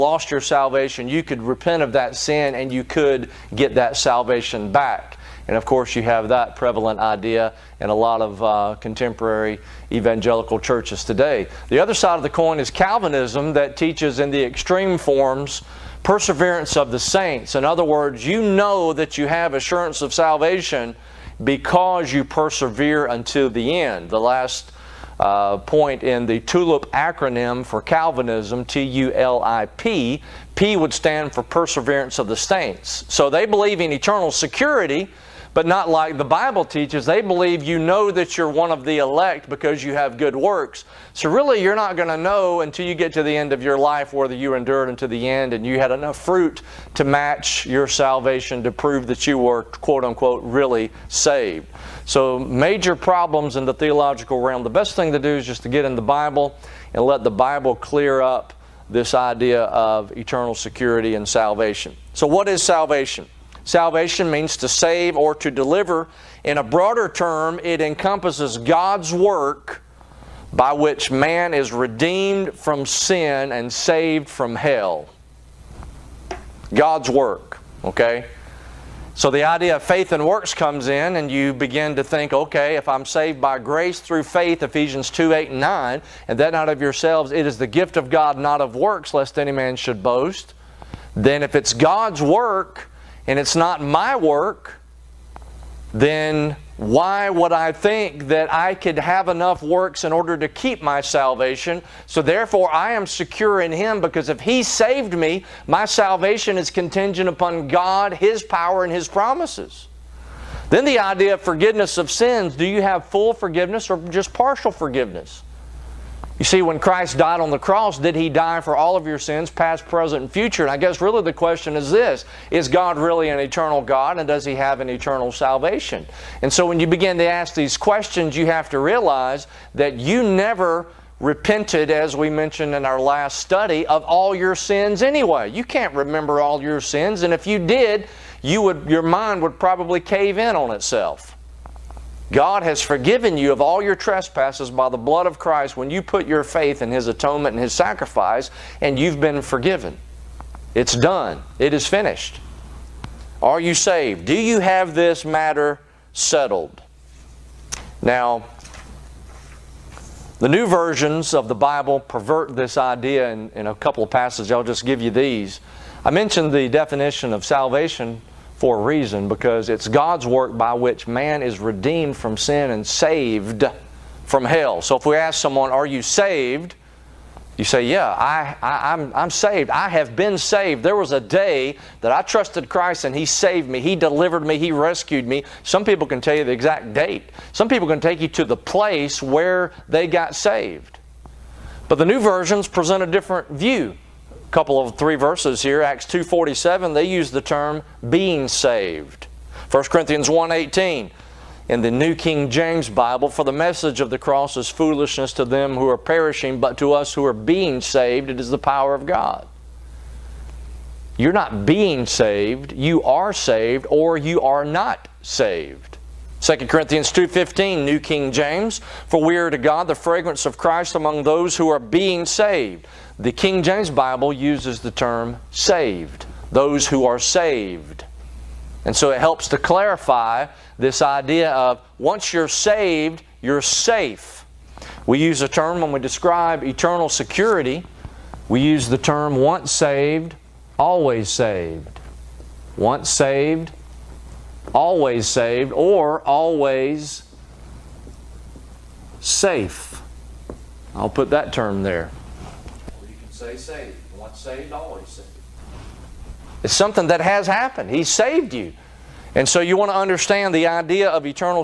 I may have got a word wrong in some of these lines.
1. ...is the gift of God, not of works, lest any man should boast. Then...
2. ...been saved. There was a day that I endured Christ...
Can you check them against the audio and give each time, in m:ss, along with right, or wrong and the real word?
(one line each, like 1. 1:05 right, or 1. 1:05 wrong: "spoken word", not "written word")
1. 1:27 right
2. 3:00 wrong: "trusted", not "endured".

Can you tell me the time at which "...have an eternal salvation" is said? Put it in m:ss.
2:04.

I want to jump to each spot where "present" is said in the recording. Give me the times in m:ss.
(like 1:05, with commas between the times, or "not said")
1:59, 3:12.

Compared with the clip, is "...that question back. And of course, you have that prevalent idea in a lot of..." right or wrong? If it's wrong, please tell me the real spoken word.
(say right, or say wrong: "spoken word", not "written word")
wrong: "salvation", not "question".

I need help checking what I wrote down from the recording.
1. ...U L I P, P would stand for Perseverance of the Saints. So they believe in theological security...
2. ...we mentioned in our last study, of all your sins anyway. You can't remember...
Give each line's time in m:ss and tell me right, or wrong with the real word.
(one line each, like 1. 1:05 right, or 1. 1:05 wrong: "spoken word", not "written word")
1. 0:28 wrong: "eternal", not "theological"
2. 2:12 right.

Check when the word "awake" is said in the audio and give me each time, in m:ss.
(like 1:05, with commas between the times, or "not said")
not said.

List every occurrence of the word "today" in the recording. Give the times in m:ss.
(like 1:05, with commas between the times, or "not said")
0:11.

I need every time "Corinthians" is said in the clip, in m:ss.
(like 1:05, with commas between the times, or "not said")
3:19, 3:36.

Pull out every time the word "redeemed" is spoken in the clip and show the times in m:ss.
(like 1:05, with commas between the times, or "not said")
1:11, 2:51.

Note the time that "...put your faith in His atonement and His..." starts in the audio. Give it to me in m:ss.
2:26.